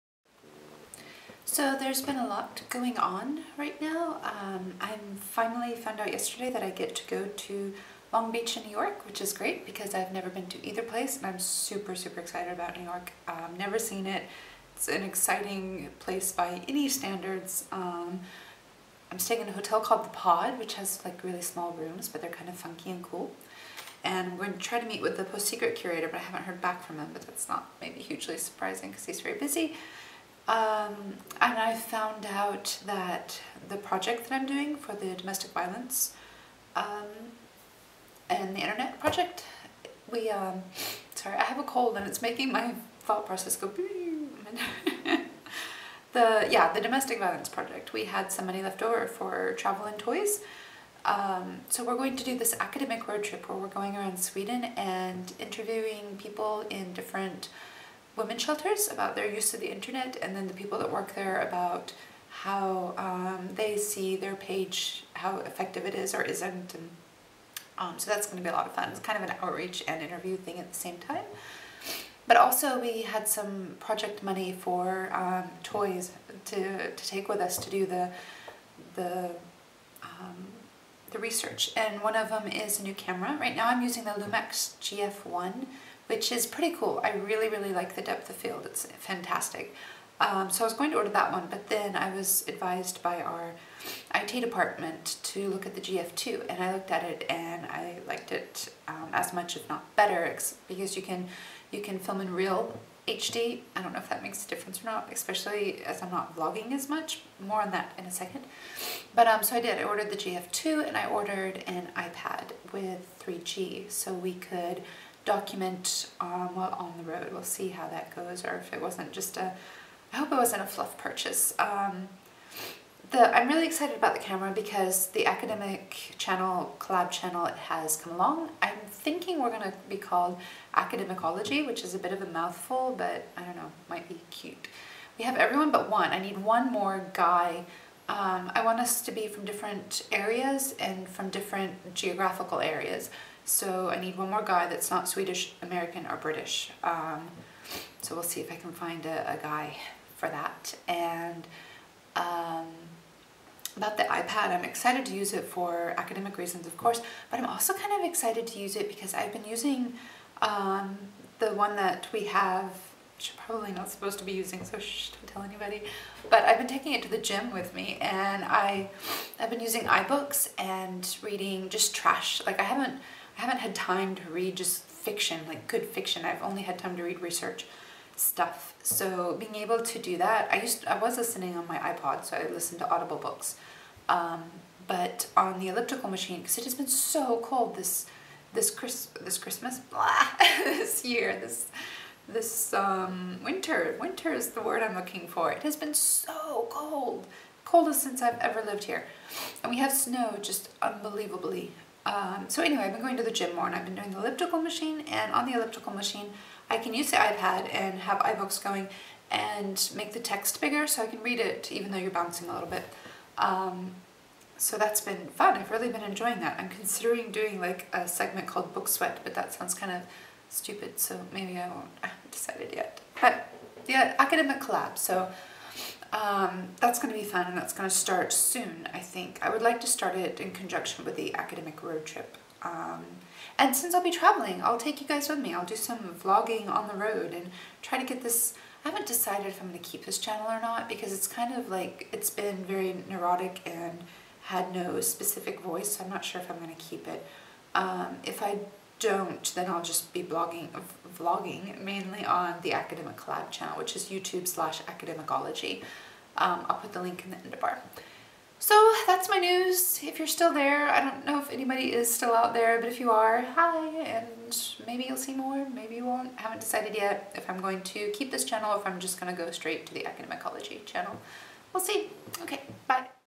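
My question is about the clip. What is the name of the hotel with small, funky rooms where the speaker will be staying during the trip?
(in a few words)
The Pod.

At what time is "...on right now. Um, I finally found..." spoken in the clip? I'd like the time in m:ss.
0:02.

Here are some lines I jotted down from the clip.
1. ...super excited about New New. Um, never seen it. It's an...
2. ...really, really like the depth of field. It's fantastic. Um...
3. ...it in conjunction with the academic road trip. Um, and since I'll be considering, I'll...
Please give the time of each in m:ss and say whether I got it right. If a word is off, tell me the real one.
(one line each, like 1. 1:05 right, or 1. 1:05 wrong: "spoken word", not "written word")
1. 0:11 wrong: "York", not "New"
2. 1:27 right
3. 3:50 wrong: "traveling", not "considering".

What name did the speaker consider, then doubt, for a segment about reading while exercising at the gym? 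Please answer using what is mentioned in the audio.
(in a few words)
Book Sweat.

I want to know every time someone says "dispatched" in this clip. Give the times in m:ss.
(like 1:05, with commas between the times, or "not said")
not said.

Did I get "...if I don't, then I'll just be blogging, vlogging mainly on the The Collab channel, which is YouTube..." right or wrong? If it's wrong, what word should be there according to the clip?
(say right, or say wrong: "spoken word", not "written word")
wrong: "Academic", not "The".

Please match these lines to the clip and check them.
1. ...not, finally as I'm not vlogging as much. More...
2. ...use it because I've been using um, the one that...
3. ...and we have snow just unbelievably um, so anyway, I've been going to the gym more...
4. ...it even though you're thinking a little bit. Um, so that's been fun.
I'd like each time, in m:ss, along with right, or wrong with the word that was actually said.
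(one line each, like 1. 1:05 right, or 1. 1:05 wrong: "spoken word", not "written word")
1. 1:44 wrong: "especially", not "finally"
2. 2:38 right
3. 3:19 right
4. 3:31 wrong: "bouncing", not "thinking".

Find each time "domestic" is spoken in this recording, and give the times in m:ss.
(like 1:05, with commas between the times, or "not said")
0:35, 0:46.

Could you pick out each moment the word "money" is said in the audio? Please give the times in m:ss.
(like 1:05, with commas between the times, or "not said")
0:48, 1:14.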